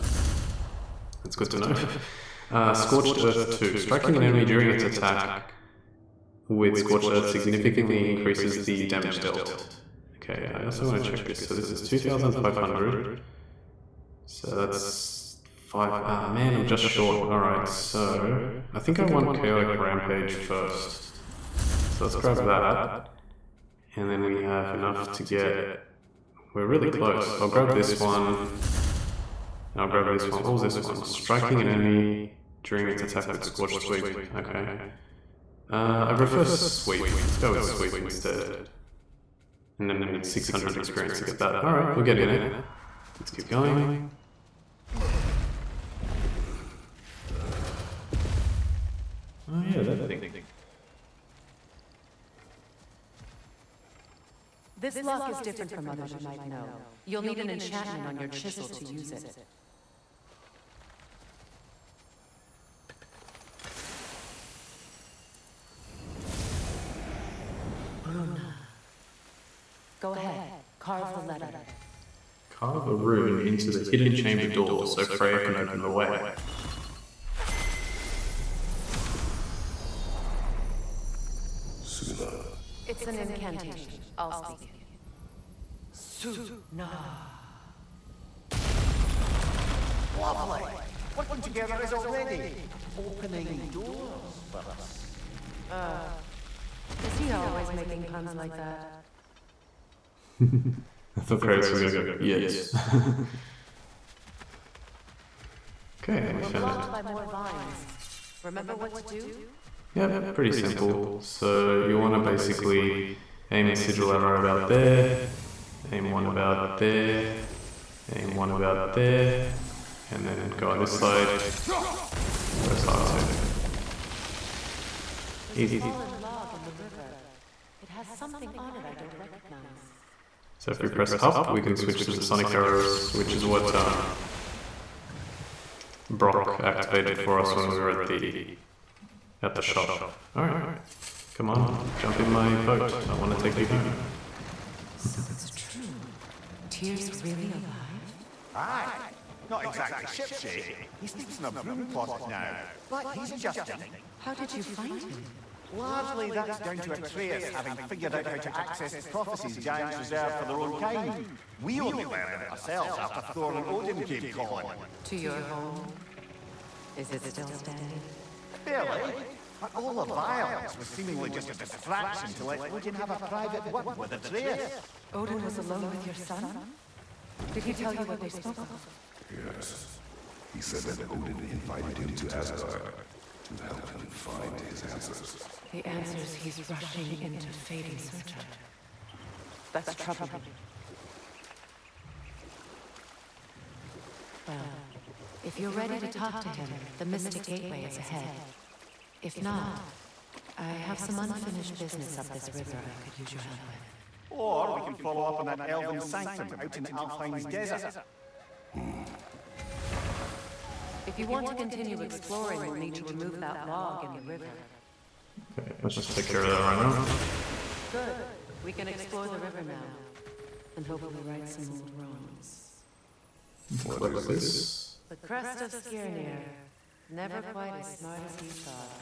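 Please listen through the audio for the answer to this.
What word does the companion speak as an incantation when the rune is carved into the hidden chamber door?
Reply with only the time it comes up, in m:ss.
1:25.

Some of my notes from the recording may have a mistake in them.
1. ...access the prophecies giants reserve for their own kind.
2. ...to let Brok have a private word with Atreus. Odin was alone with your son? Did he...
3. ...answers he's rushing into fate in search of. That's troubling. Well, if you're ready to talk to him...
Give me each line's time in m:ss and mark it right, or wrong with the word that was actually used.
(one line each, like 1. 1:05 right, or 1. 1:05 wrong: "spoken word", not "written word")
1. 2:38 right
2. 2:52 wrong: "Odin", not "Brok"
3. 3:05 right.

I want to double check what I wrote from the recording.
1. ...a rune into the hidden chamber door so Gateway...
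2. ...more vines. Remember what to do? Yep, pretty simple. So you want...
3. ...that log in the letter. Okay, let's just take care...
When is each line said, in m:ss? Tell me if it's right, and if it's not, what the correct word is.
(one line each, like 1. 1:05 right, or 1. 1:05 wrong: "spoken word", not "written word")
1. 1:12 wrong: "Freya", not "Gateway"
2. 1:47 right
3. 3:33 wrong: "river", not "letter".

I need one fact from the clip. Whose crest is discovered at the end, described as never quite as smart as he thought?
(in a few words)
Skirnir.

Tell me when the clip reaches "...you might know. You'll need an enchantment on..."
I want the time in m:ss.
0:56.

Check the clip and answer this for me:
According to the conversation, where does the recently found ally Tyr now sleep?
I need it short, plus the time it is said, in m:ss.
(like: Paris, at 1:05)
A broom closet, at 2:31.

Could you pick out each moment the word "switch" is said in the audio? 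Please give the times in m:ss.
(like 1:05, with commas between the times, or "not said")
2:11.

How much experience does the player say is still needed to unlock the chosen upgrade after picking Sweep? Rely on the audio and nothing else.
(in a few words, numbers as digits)
600.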